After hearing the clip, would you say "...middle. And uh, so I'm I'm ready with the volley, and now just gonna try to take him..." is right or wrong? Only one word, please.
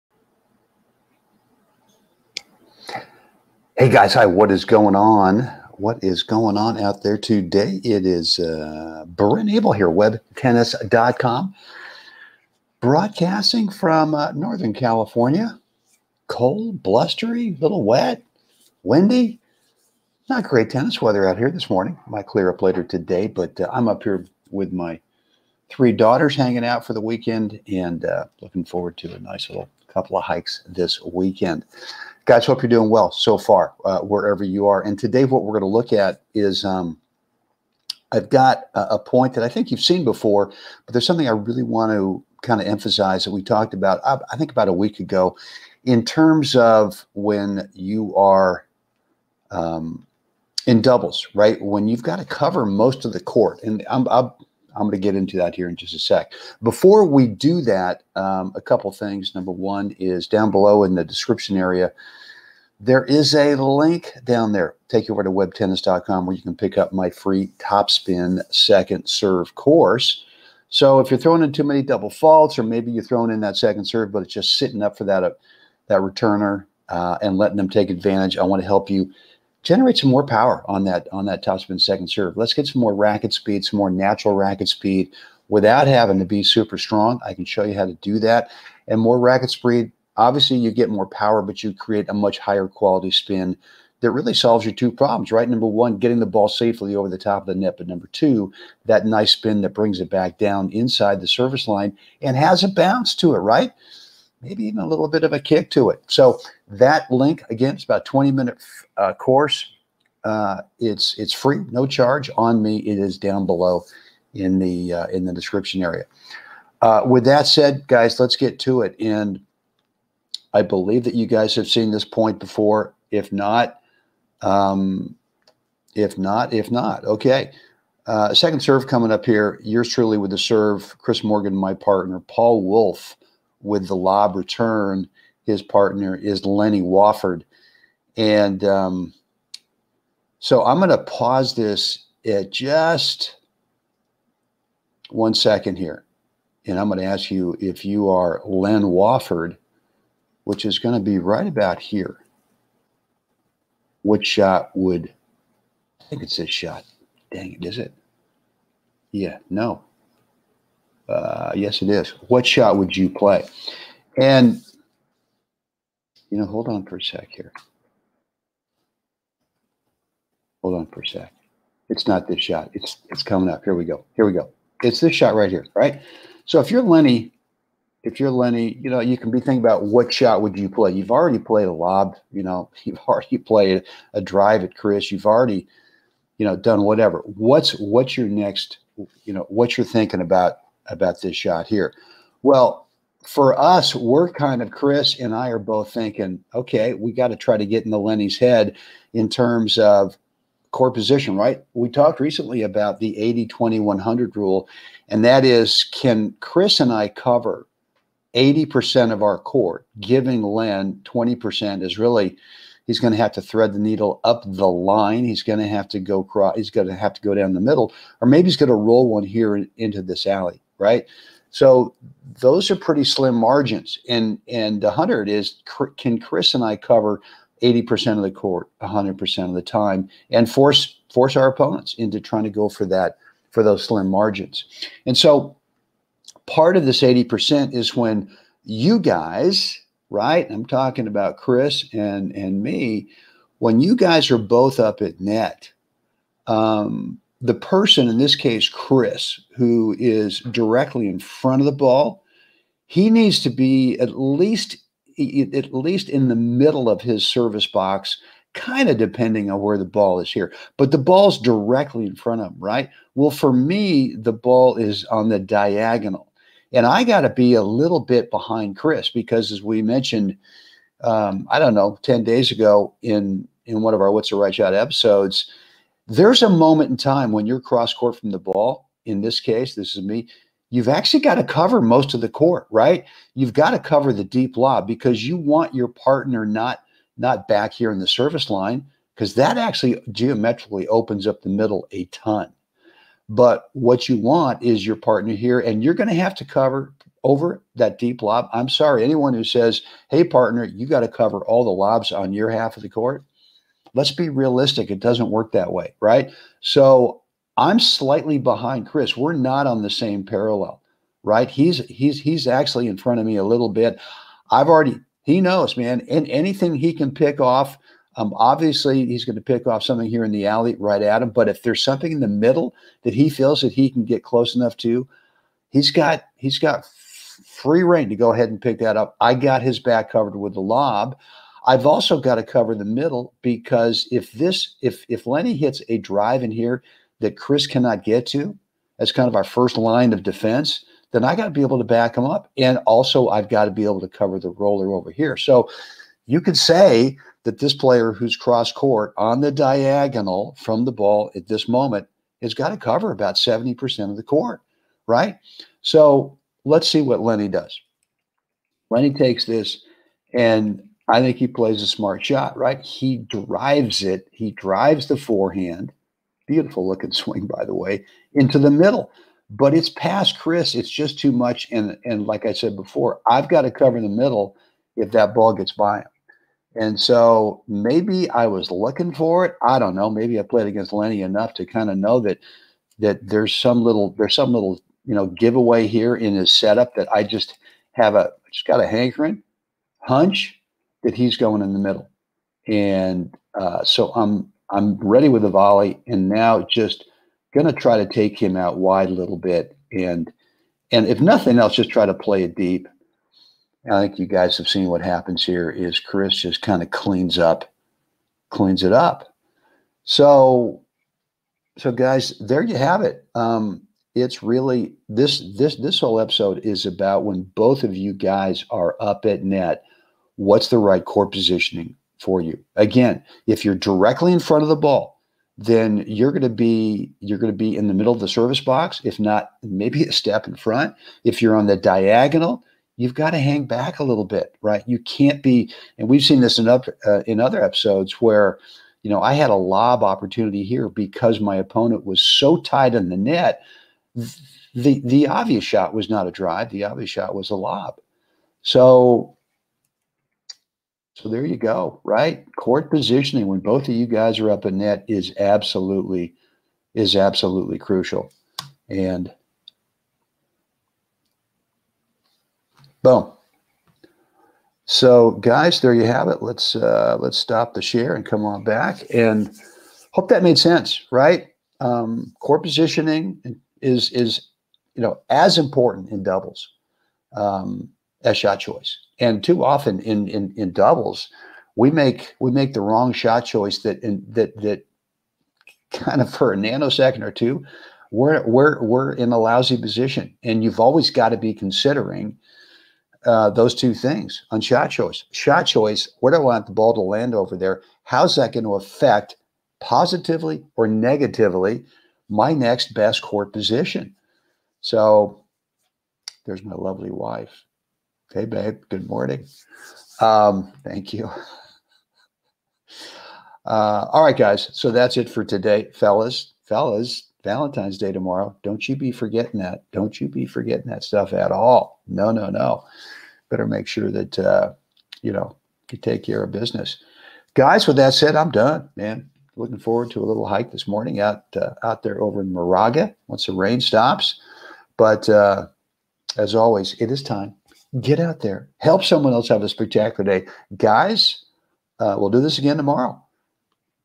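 right.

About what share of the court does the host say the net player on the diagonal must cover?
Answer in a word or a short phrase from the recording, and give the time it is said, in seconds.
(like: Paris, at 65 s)
70%, at 353 s.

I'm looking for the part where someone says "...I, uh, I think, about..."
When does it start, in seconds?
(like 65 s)
44 s.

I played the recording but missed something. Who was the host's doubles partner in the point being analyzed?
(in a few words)
Chris Morgan.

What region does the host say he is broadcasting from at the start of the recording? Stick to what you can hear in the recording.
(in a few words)
Northern California.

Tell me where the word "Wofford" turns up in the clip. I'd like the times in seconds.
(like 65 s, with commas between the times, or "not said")
136 s, 148 s.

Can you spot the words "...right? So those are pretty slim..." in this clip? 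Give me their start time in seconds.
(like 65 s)
220 s.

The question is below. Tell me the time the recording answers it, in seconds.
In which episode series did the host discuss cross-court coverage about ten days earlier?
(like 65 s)
274 s.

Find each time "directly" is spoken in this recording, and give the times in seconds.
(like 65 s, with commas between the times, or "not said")
250 s, 261 s, 423 s.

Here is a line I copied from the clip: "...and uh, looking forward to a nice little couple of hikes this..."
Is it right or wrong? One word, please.
right.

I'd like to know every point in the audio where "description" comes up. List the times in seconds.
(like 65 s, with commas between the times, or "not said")
61 s, 115 s.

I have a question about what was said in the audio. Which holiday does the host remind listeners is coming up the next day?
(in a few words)
Valentine's Day.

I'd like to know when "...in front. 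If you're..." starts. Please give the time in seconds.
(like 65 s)
430 s.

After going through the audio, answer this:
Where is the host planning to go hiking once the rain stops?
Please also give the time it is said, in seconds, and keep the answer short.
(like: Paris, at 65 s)
Moraga, at 532 s.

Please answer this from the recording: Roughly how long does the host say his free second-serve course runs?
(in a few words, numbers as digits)
20 minutes.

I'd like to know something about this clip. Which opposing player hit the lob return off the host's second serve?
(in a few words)
Paul Wolf.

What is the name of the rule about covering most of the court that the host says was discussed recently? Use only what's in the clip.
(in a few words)
80 20 100 rule.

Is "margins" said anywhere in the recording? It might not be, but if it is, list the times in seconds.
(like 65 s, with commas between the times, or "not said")
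223 s, 234 s.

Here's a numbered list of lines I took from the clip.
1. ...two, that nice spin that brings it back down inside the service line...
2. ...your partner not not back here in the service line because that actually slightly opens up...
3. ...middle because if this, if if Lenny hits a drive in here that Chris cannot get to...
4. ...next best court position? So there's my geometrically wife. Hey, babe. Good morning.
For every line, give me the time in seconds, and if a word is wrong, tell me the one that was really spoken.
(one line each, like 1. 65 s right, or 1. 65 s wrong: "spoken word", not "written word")
1. 98 s right
2. 285 s wrong: "geometrically", not "slightly"
3. 332 s right
4. 502 s wrong: "lovely", not "geometrically".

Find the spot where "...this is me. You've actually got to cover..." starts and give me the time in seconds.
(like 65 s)
279 s.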